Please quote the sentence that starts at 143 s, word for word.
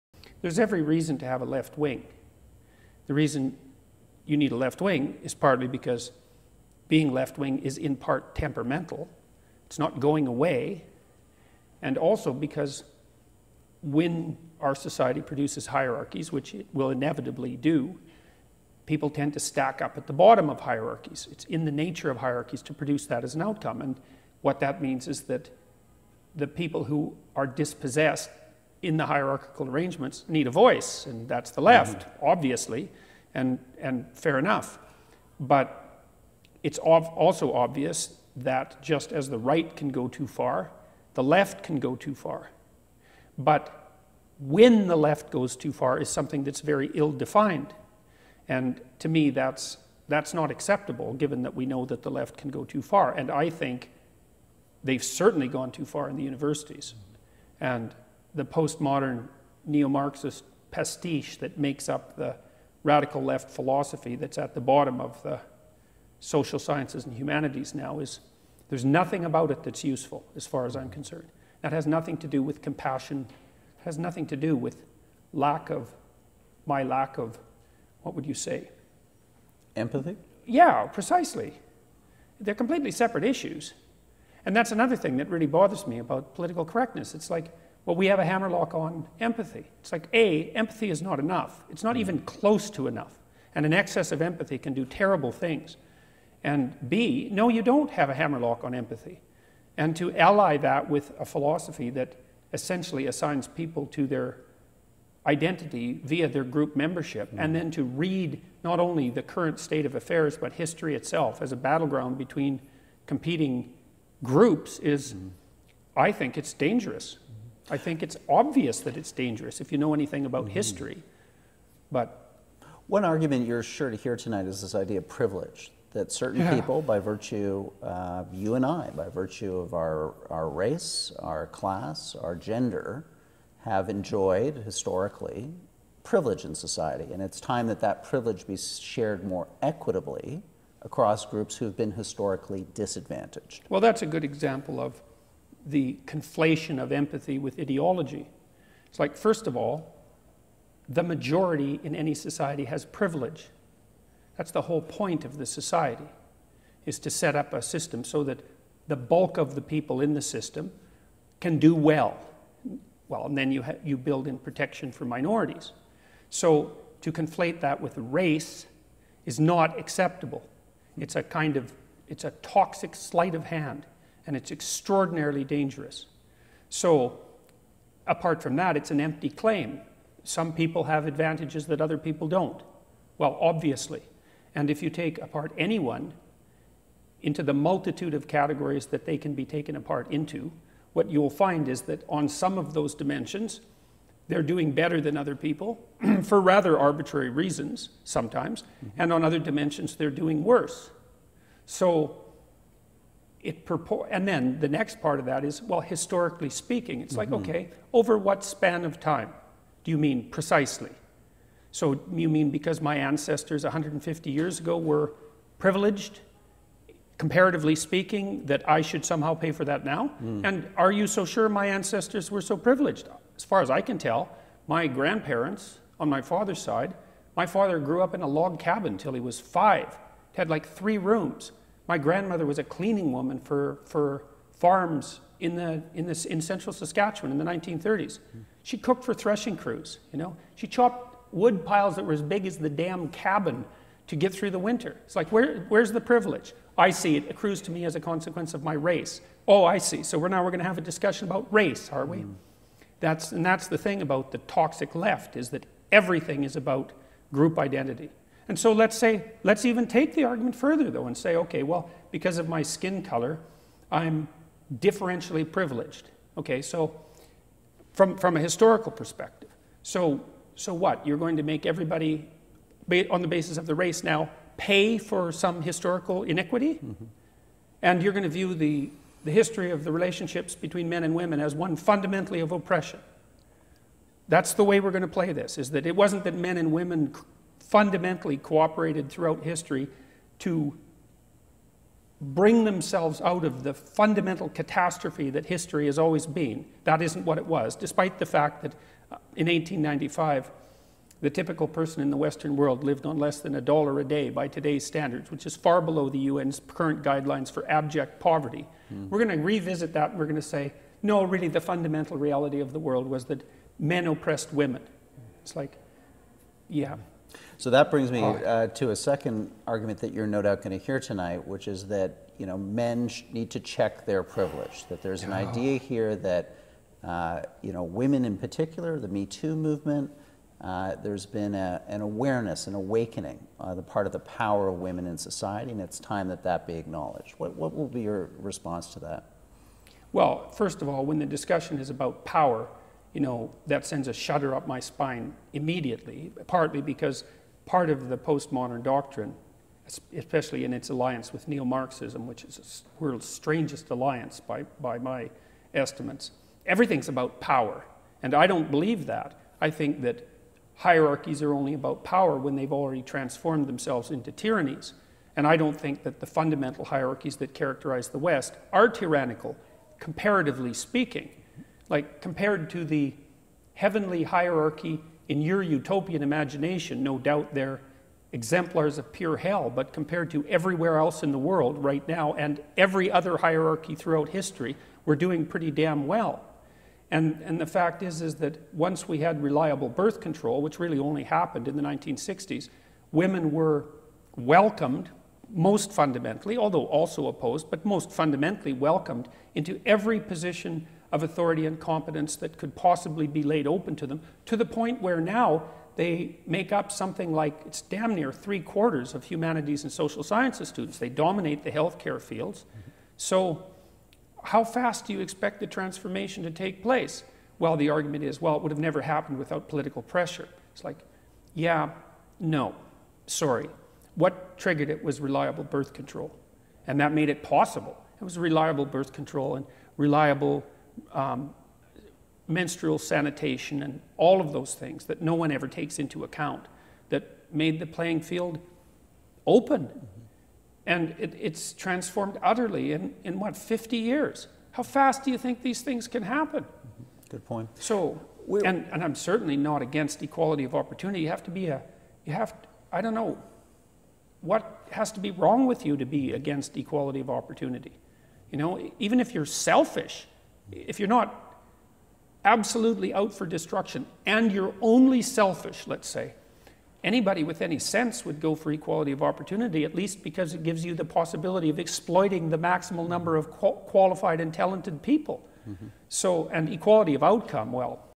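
Well, that's a good example of the conflation of empathy with ideology.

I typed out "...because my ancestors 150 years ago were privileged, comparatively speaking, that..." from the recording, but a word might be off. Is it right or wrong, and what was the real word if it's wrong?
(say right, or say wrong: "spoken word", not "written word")
right.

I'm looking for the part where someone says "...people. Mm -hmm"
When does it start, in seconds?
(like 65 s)
475 s.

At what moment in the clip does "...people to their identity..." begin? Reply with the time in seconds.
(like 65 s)
103 s.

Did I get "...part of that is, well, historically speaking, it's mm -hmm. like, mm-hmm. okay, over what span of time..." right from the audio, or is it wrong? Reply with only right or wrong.
right.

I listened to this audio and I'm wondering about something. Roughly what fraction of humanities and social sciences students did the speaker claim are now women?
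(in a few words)
three quarters.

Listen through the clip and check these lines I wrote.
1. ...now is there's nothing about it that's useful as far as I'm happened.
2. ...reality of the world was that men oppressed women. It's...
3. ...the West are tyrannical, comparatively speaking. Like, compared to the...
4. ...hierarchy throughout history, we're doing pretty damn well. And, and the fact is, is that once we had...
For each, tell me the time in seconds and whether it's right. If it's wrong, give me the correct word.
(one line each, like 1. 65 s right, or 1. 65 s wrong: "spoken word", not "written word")
1. 67 s wrong: "concerned", not "happened"
2. 312 s right
3. 368 s right
4. 383 s right.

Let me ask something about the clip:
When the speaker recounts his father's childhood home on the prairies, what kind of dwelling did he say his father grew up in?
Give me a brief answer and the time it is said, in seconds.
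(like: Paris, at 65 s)
log cabin, at 228 s.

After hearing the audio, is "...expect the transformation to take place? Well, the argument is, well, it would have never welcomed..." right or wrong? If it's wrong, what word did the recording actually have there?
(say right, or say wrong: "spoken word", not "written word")
wrong: "happened", not "welcomed".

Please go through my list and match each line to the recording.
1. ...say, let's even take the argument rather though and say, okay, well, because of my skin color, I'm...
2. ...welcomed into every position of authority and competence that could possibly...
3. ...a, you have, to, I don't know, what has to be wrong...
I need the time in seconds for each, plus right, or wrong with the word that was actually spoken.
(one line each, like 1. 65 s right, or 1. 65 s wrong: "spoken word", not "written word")
1. 258 s wrong: "further", not "rather"
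2. 398 s right
3. 451 s right.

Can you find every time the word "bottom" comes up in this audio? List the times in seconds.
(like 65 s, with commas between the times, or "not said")
20 s, 64 s.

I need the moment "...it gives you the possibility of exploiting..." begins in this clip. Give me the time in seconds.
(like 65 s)
470 s.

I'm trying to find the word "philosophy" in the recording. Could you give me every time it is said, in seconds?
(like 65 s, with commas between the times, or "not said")
63 s, 101 s.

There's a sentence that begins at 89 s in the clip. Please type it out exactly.
It's like, A, empathy is not enough.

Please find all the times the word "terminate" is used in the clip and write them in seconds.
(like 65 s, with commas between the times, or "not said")
not said.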